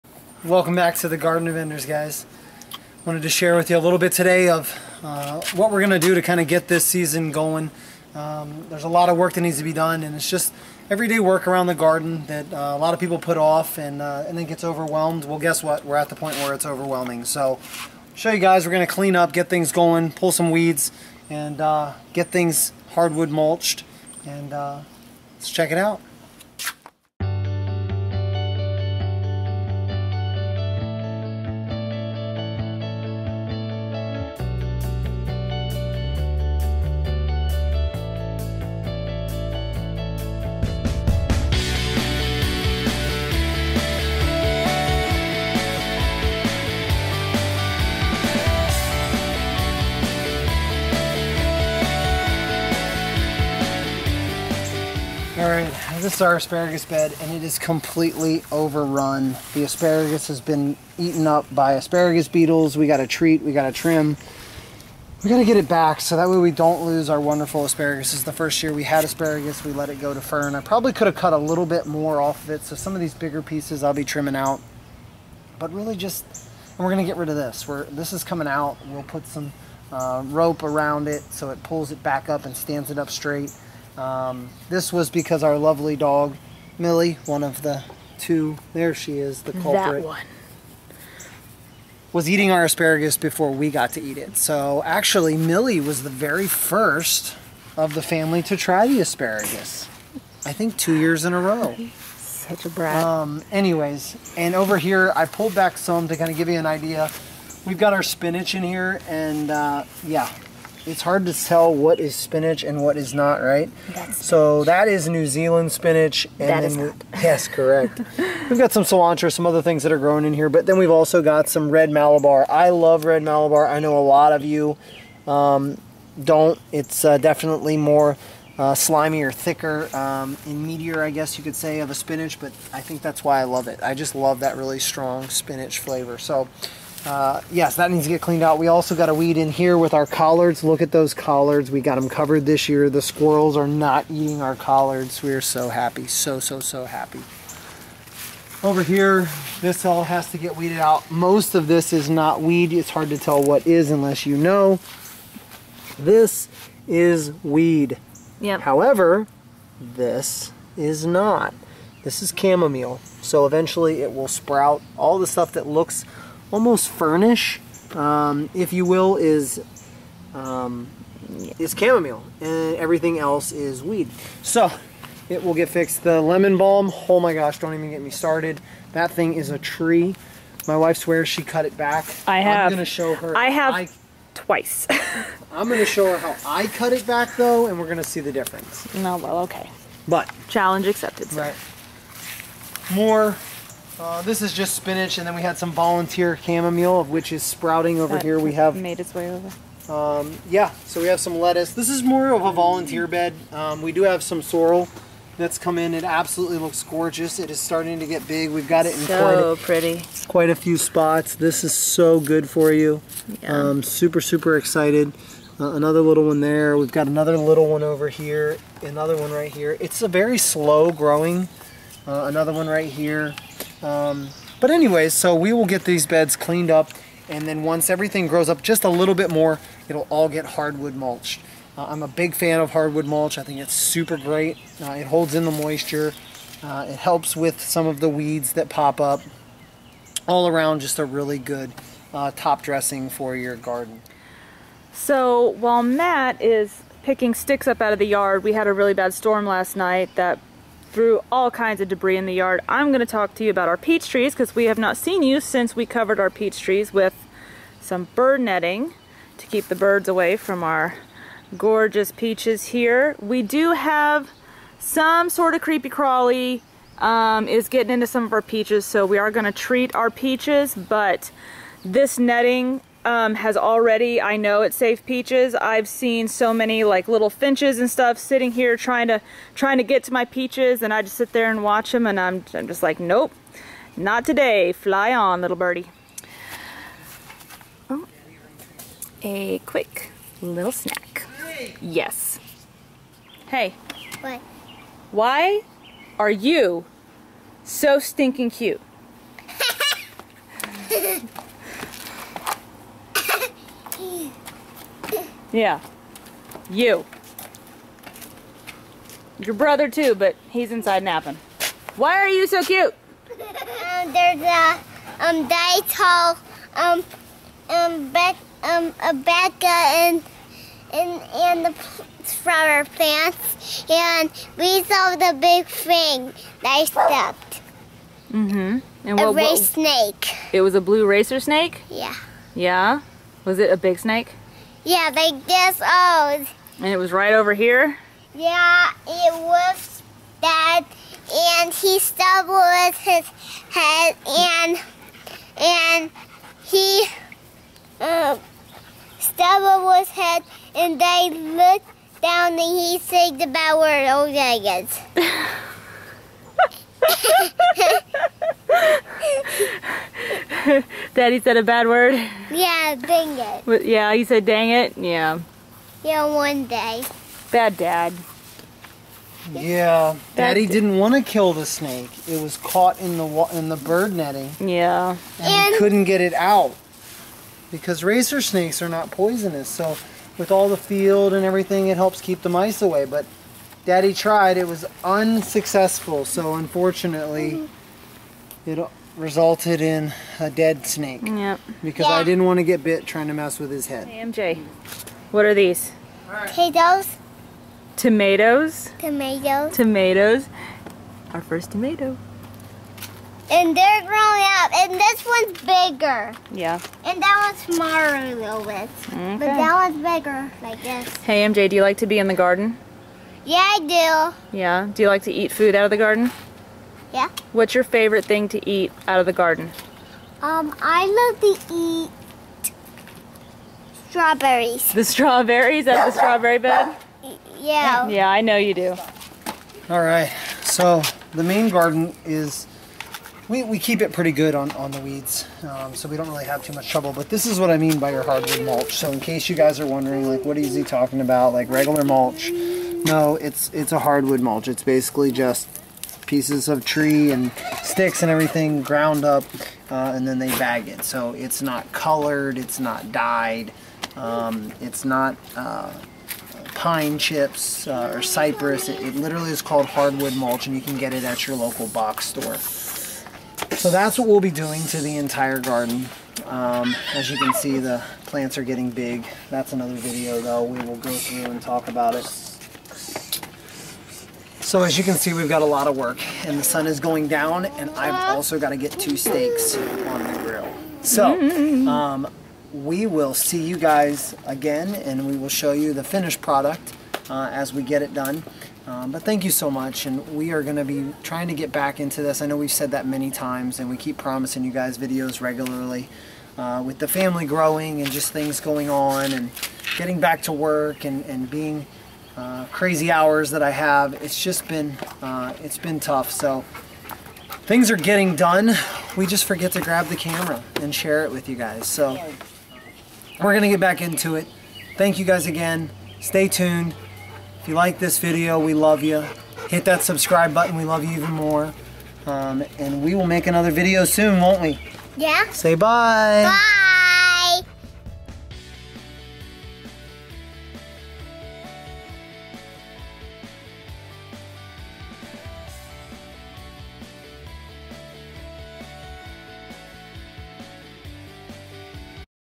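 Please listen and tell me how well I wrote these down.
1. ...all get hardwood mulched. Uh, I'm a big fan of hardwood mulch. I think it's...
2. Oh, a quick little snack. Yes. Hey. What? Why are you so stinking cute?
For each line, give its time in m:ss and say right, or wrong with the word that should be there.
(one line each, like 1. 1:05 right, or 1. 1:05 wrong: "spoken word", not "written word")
1. 3:50 right
2. 4:47 right.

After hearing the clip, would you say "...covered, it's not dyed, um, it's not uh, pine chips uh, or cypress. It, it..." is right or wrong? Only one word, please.
wrong.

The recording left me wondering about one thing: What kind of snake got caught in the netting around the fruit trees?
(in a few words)
blue racer snake.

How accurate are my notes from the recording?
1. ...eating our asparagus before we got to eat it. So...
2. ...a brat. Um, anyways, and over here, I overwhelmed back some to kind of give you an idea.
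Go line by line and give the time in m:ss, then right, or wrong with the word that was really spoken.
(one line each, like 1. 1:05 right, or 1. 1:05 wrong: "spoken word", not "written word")
1. 1:32 right
2. 1:42 wrong: "pulled", not "overwhelmed".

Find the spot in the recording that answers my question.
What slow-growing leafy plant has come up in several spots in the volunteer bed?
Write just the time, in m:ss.
3:24.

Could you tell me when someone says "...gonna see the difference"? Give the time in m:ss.
3:07.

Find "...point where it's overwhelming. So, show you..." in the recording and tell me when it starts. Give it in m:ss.
0:16.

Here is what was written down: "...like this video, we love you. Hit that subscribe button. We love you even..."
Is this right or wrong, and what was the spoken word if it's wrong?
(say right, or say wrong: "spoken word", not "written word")
right.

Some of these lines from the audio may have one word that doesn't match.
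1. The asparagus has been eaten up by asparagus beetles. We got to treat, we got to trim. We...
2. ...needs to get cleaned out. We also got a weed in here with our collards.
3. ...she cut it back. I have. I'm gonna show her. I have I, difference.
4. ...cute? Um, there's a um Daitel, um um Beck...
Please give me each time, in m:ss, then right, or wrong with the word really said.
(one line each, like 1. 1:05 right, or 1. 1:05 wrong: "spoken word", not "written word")
1. 0:59 right
2. 2:17 right
3. 3:01 wrong: "twice", not "difference"
4. 5:12 right.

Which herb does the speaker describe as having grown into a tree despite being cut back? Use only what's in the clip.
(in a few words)
lemon balm.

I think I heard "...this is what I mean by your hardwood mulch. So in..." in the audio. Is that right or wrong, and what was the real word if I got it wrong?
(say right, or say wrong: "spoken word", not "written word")
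right.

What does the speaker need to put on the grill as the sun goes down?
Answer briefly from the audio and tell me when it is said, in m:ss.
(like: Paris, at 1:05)
two steaks, at 7:58.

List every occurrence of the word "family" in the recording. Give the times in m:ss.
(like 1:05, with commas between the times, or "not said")
1:38, 8:17.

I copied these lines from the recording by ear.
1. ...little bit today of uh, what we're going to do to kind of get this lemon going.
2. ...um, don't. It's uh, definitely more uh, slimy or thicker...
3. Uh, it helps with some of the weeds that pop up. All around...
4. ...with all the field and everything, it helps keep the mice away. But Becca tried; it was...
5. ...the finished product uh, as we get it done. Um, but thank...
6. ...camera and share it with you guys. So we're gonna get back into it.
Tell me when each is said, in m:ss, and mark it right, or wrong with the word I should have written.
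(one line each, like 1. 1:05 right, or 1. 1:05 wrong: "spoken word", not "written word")
1. 0:03 wrong: "season", not "lemon"
2. 2:05 right
3. 3:56 right
4. 6:20 wrong: "Daddy", not "Becca"
5. 8:05 right
6. 8:30 right.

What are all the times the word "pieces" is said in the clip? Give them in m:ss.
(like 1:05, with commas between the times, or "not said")
1:13, 7:26.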